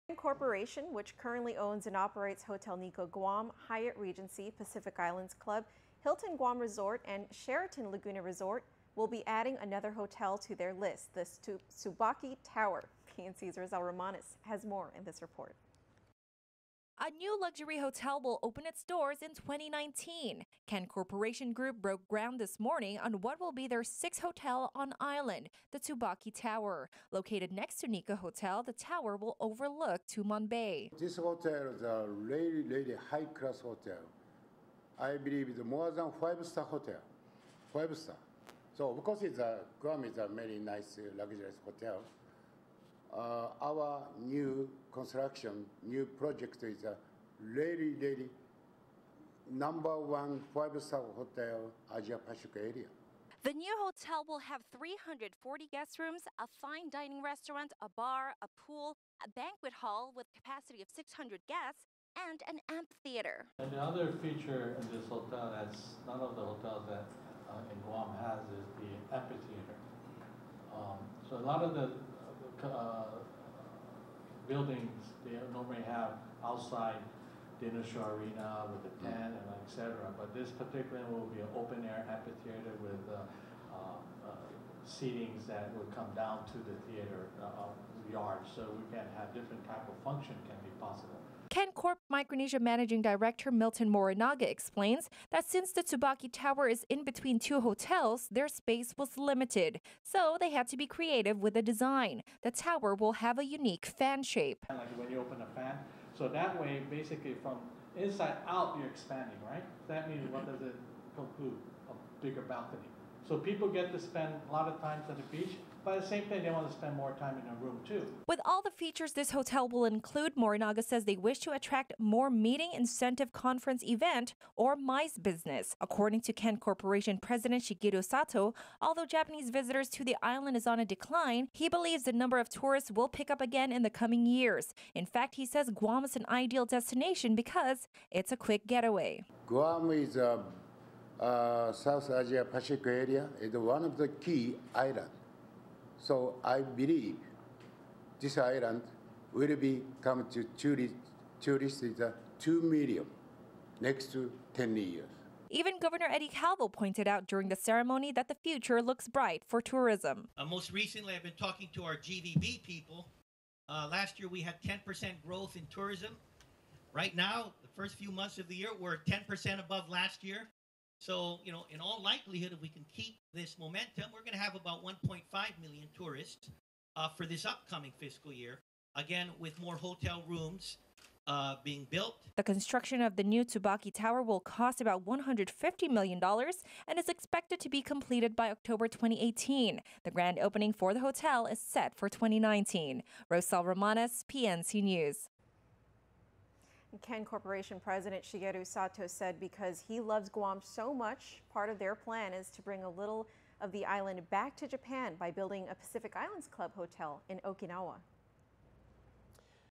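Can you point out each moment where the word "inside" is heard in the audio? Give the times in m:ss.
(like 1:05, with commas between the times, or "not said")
1:47.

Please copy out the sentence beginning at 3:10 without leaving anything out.
The grand opening for the hotel is set for 2019.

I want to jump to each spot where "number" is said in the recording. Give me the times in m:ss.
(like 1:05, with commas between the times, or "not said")
0:49, 2:12.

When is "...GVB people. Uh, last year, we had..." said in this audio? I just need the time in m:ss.
2:41.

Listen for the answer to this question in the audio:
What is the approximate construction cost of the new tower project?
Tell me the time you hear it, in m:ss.
3:05.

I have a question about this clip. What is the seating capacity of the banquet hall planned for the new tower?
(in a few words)
600 guests.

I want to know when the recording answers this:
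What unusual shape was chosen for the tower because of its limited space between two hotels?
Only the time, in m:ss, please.
1:43.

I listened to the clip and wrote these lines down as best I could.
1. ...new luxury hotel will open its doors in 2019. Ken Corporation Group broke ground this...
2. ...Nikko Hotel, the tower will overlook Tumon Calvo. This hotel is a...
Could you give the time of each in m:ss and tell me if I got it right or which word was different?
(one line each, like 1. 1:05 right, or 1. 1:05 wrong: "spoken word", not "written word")
1. 0:17 right
2. 0:27 wrong: "Bay", not "Calvo".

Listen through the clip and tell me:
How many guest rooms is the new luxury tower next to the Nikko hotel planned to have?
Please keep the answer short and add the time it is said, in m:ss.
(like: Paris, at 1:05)
340, at 0:54.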